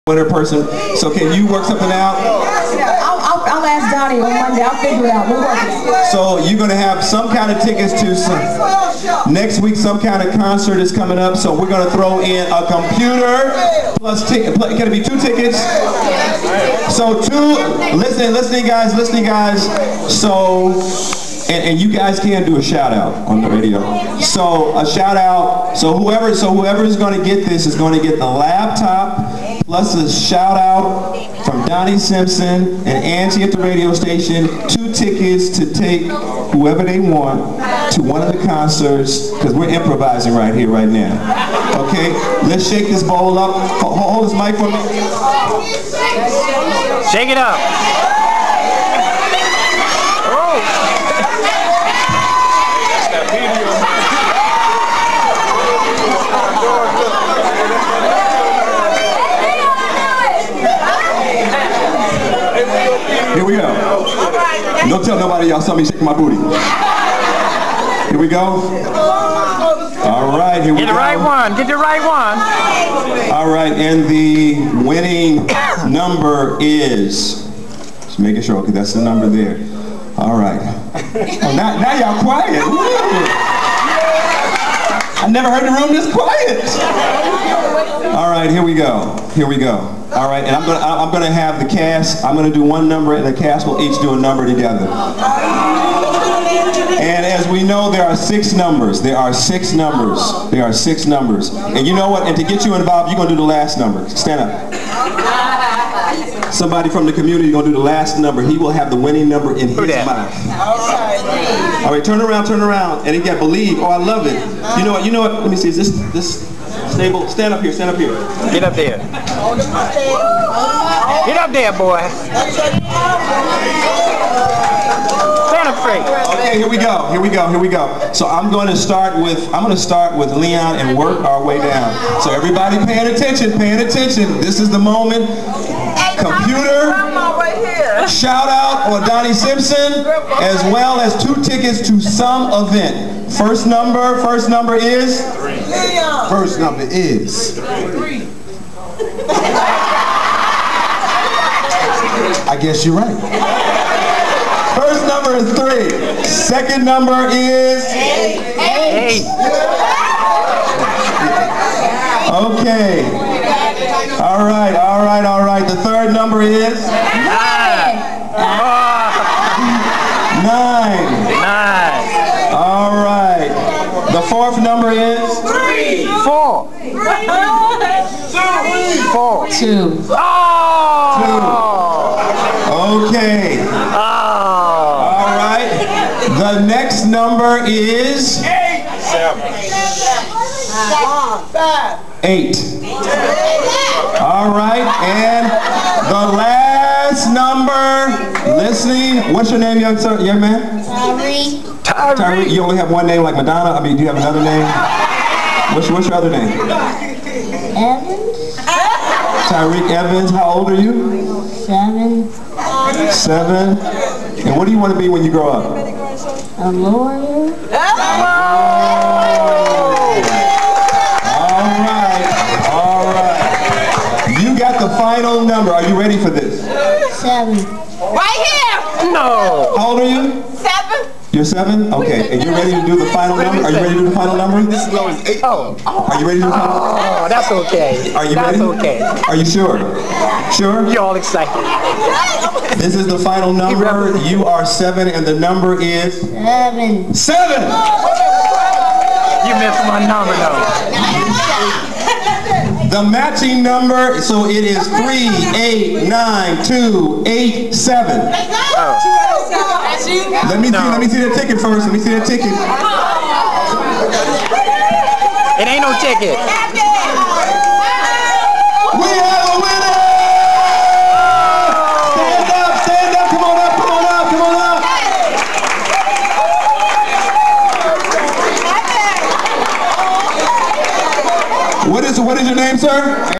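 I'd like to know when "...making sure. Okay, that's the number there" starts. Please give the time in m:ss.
1:18.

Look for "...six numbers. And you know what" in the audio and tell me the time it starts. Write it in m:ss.
1:40.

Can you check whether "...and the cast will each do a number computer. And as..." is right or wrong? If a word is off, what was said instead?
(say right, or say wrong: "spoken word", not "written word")
wrong: "together", not "computer".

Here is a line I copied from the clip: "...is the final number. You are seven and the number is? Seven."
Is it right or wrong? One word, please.
right.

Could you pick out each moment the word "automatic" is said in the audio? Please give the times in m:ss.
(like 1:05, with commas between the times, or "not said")
not said.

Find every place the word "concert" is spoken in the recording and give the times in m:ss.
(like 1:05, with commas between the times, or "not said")
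0:10, 0:38.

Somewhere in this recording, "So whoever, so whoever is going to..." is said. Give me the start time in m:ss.
0:25.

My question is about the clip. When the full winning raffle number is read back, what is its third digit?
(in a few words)
9.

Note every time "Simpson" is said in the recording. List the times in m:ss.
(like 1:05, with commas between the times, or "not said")
0:31, 2:19.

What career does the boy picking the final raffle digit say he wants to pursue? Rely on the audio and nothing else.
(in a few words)
A lawyer.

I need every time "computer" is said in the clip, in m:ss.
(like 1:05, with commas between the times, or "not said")
0:12, 2:16.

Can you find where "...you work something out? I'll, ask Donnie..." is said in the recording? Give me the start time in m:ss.
0:01.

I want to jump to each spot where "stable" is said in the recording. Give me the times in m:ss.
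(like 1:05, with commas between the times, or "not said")
1:56.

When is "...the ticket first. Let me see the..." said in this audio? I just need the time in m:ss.
4:21.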